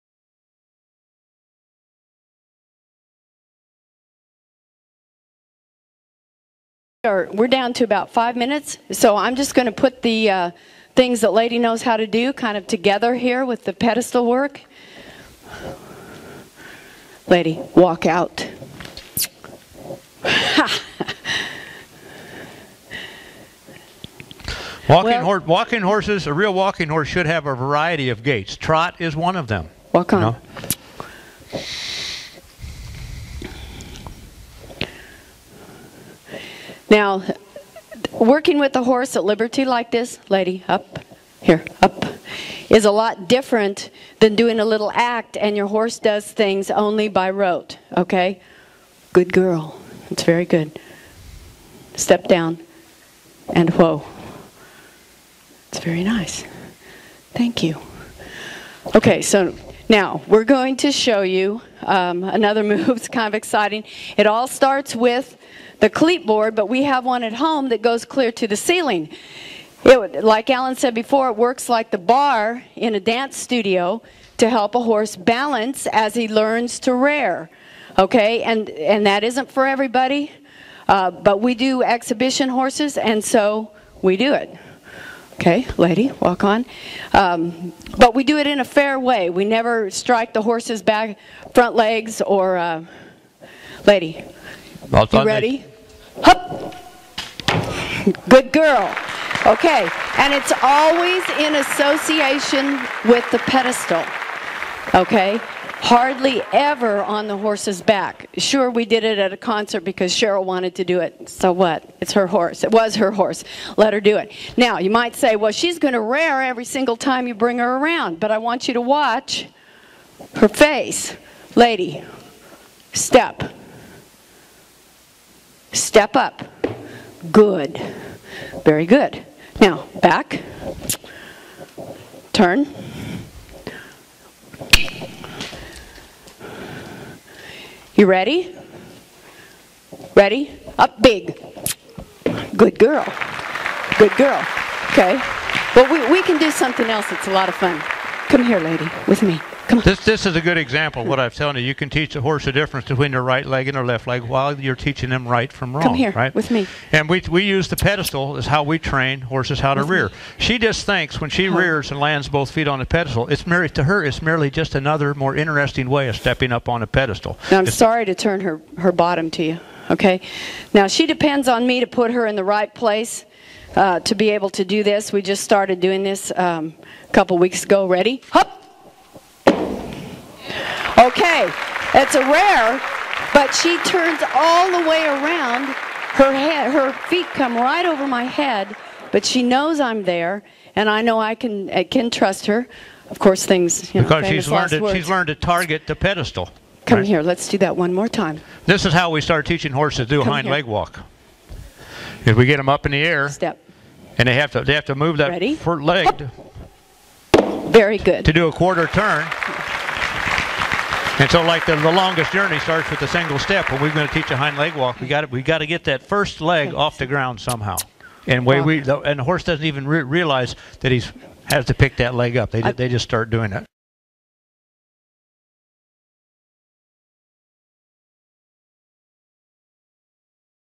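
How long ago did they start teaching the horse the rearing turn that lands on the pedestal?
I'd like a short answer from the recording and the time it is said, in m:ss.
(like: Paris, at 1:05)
a couple weeks ago, at 2:57.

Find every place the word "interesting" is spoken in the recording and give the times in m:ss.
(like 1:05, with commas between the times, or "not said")
2:45.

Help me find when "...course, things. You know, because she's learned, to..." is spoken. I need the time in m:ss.
3:13.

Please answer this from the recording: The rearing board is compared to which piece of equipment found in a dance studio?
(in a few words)
the bar.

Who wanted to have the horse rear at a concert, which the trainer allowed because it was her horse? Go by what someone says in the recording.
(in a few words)
Cheryl.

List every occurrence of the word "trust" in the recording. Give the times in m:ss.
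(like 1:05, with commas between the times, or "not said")
3:12.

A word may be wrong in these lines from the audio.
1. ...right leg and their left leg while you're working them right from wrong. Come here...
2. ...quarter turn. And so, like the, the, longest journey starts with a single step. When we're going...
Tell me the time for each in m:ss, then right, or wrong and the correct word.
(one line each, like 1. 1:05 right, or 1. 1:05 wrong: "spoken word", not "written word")
1. 2:33 wrong: "teaching", not "working"
2. 3:28 right.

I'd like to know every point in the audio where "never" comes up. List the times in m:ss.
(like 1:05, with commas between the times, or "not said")
1:29.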